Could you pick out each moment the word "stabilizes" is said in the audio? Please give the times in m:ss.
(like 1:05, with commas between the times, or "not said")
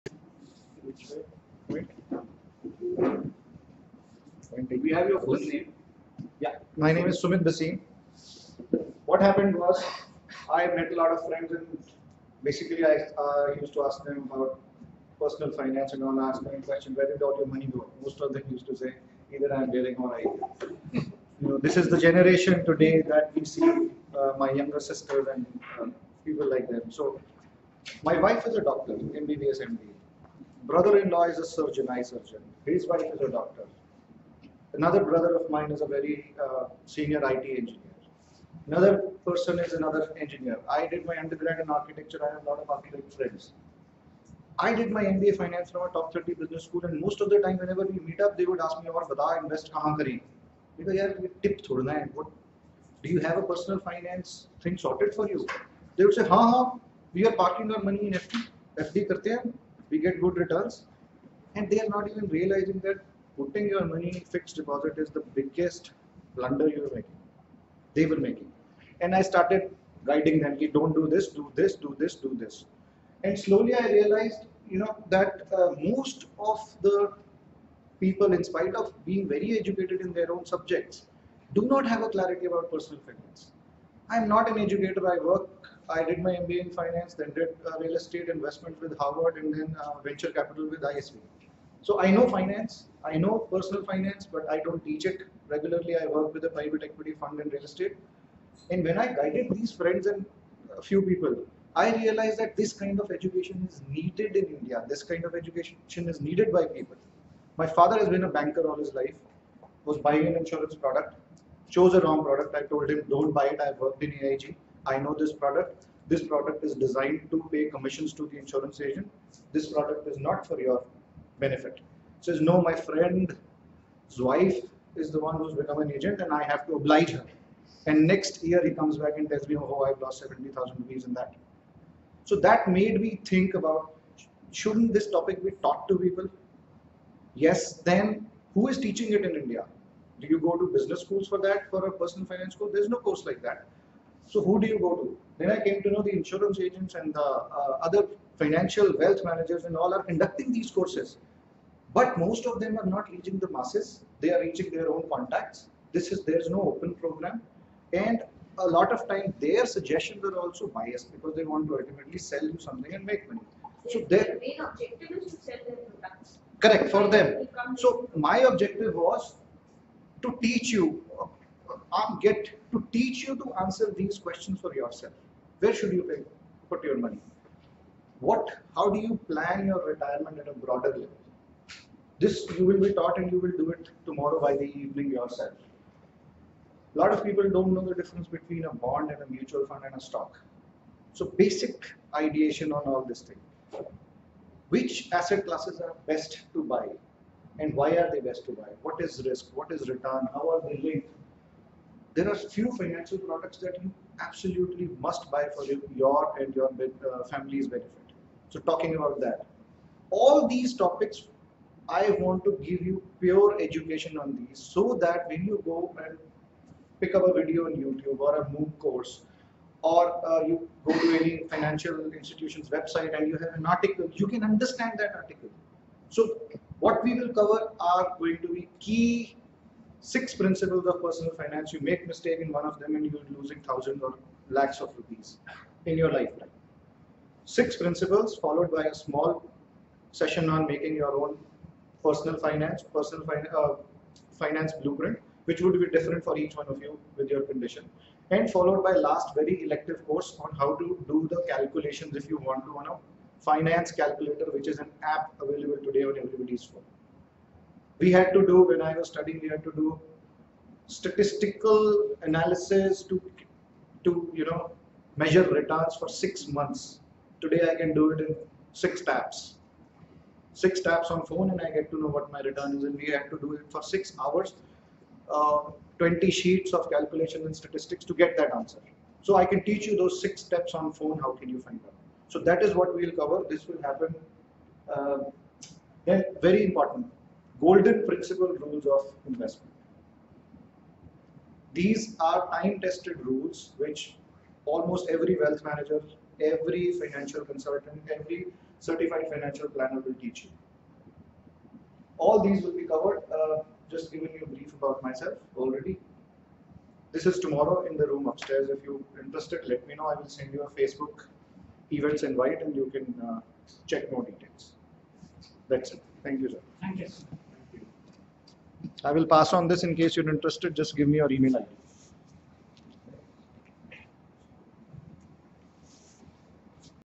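not said.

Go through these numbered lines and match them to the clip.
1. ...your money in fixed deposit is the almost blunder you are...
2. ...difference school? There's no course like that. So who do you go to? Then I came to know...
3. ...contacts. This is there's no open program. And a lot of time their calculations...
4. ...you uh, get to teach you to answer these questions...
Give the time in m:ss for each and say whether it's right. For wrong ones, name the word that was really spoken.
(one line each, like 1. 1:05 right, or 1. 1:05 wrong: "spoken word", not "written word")
1. 1:03 wrong: "biggest", not "almost"
2. 2:22 wrong: "finance", not "difference"
3. 2:35 wrong: "suggestions", not "calculations"
4. 2:50 right.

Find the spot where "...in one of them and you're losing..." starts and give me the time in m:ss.
3:52.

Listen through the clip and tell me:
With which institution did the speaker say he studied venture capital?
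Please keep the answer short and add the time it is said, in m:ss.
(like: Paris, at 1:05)
ISB, at 1:30.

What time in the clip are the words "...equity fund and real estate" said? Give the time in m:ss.
1:36.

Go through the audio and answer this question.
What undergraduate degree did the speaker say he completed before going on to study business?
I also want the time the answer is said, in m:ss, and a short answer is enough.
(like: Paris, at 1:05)
Architecture, at 0:41.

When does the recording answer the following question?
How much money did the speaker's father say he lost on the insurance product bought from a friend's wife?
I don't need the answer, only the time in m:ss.
2:10.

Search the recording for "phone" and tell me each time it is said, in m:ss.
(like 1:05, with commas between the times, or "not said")
4:16, 4:31, 4:40.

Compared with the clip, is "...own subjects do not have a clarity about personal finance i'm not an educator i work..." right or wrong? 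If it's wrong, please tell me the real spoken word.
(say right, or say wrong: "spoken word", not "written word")
right.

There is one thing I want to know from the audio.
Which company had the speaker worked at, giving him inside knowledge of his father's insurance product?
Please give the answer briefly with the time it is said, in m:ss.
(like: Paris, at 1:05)
AIG, at 1:54.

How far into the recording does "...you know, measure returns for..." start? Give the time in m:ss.
4:24.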